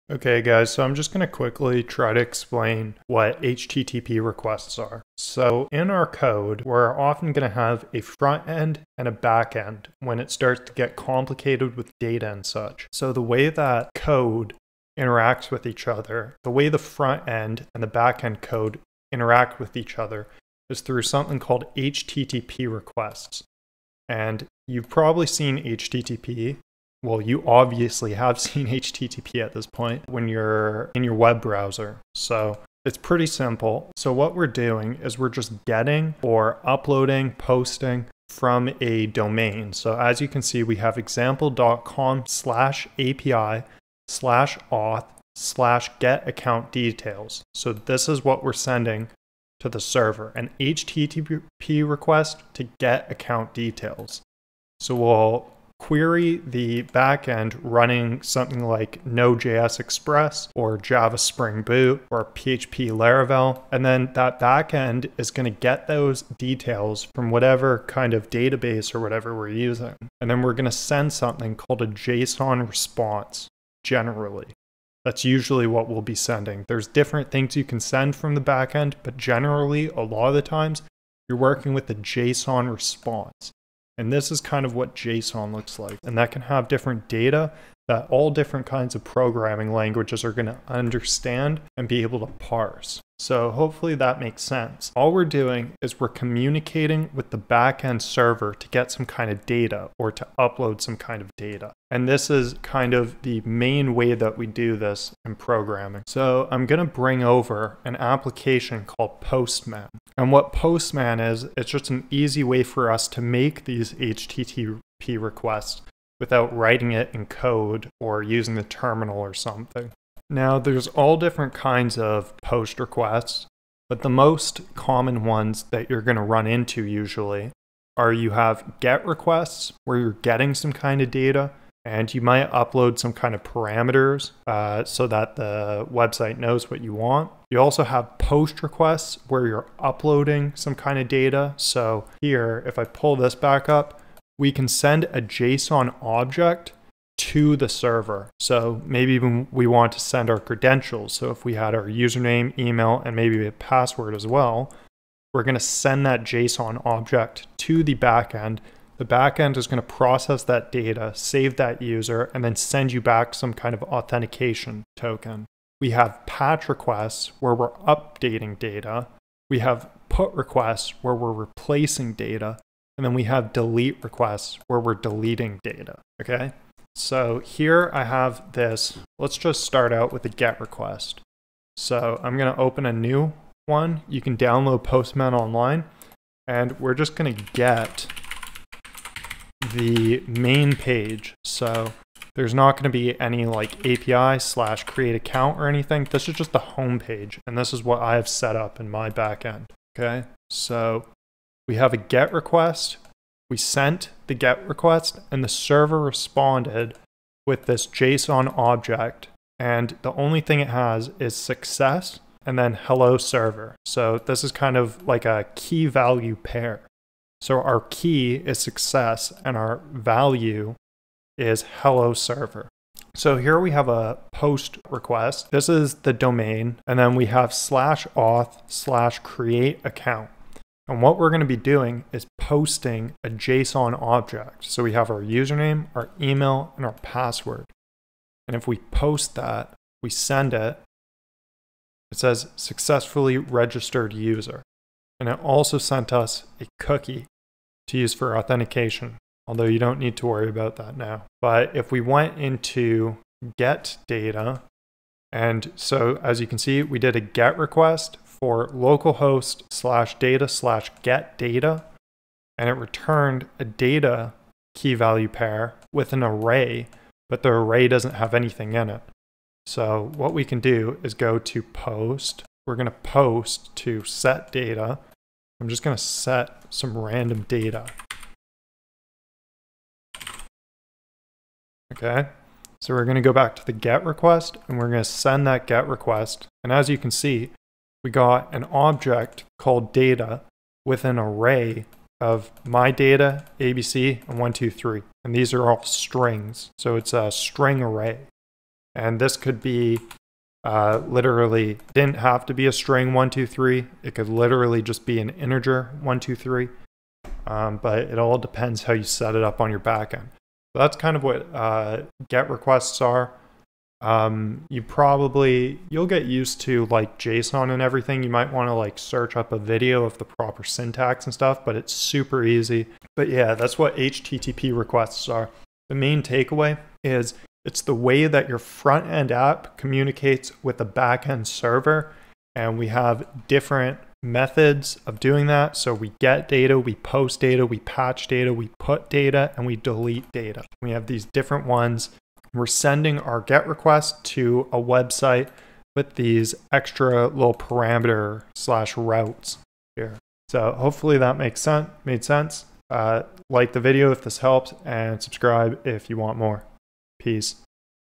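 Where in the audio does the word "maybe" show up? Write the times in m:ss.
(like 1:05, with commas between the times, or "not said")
2:28, 2:33.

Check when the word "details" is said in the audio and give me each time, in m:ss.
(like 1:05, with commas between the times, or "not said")
0:46, 0:53, 1:06.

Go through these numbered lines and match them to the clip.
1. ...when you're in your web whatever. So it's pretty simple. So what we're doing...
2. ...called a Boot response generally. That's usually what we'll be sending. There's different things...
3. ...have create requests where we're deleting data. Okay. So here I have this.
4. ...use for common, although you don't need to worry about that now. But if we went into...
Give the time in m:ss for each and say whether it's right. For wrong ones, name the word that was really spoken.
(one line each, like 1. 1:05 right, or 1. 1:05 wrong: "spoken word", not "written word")
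1. 0:30 wrong: "browser", not "whatever"
2. 1:11 wrong: "JSON", not "Boot"
3. 2:53 wrong: "delete", not "create"
4. 4:07 wrong: "authentication", not "common".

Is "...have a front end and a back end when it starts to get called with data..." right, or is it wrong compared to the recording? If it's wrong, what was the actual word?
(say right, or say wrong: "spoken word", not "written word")
wrong: "complicated", not "called".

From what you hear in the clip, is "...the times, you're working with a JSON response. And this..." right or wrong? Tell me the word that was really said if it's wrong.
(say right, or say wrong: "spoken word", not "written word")
right.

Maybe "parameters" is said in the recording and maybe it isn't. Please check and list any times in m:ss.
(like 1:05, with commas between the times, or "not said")
2:13, 5:47.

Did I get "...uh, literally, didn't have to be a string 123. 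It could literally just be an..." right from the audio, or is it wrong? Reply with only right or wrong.
right.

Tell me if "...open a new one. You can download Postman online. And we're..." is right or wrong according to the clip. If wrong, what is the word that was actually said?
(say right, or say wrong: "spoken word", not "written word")
right.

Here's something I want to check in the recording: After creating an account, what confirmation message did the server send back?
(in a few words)
successfully registered user.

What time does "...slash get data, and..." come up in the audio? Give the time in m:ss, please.
4:20.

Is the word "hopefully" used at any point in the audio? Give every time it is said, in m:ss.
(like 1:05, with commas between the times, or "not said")
1:33, 5:50.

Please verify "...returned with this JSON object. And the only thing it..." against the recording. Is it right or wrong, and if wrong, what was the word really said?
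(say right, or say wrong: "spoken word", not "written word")
wrong: "responded", not "returned".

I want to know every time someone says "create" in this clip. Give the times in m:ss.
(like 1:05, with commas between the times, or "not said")
3:14, 3:49.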